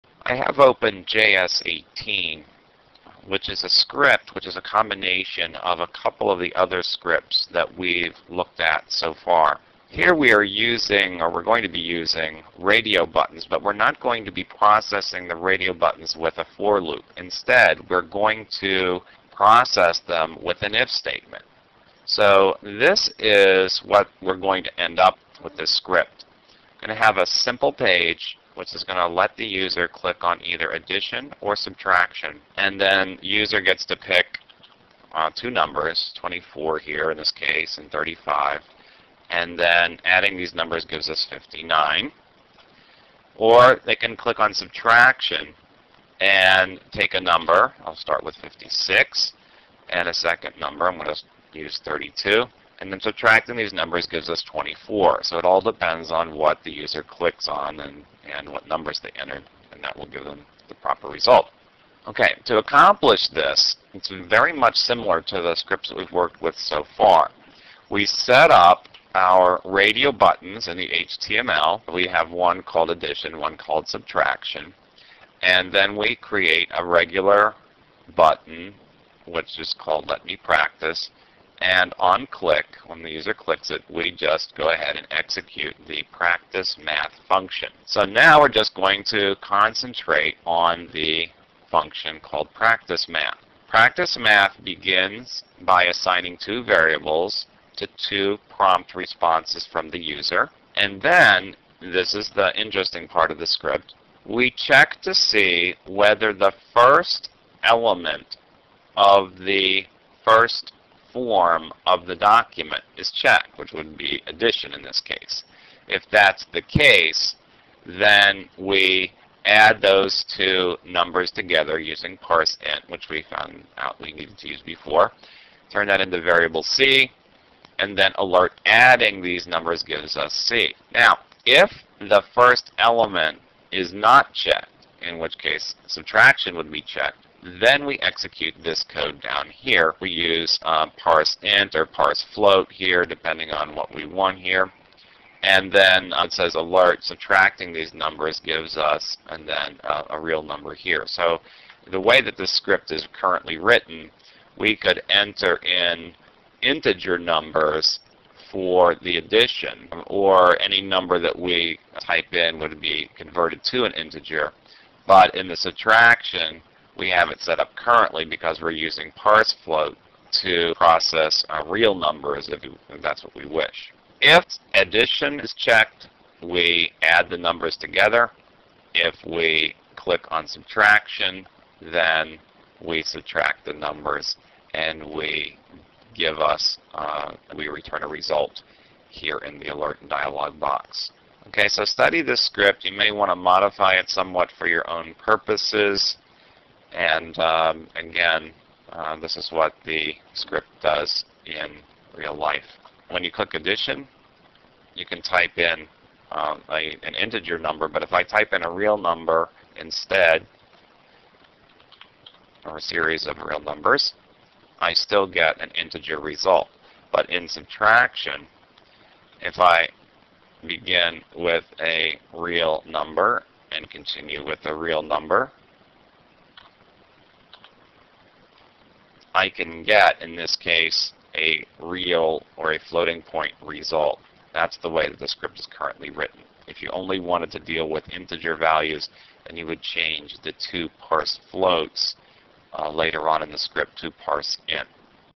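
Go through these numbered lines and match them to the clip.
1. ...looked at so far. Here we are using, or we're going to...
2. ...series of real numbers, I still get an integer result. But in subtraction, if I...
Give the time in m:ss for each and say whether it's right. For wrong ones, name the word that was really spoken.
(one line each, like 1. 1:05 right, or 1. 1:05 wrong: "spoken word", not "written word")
1. 0:08 right
2. 3:32 right.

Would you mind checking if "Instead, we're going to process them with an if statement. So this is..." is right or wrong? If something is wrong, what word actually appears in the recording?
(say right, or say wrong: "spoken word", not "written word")
right.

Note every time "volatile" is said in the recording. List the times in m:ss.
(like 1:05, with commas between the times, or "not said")
not said.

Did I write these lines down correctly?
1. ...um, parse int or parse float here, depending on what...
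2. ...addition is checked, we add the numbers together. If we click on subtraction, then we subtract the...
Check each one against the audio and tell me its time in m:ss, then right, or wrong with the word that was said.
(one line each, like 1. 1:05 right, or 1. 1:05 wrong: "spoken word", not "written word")
1. 2:20 right
2. 2:54 right.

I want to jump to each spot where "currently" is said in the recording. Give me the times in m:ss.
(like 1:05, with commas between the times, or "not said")
2:33, 2:47, 3:55.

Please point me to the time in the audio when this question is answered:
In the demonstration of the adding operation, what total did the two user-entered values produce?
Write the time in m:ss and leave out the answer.
0:41.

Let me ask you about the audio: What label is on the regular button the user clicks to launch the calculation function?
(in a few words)
Let Me Practice.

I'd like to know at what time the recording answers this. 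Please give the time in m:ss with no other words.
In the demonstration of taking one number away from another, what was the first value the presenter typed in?
0:48.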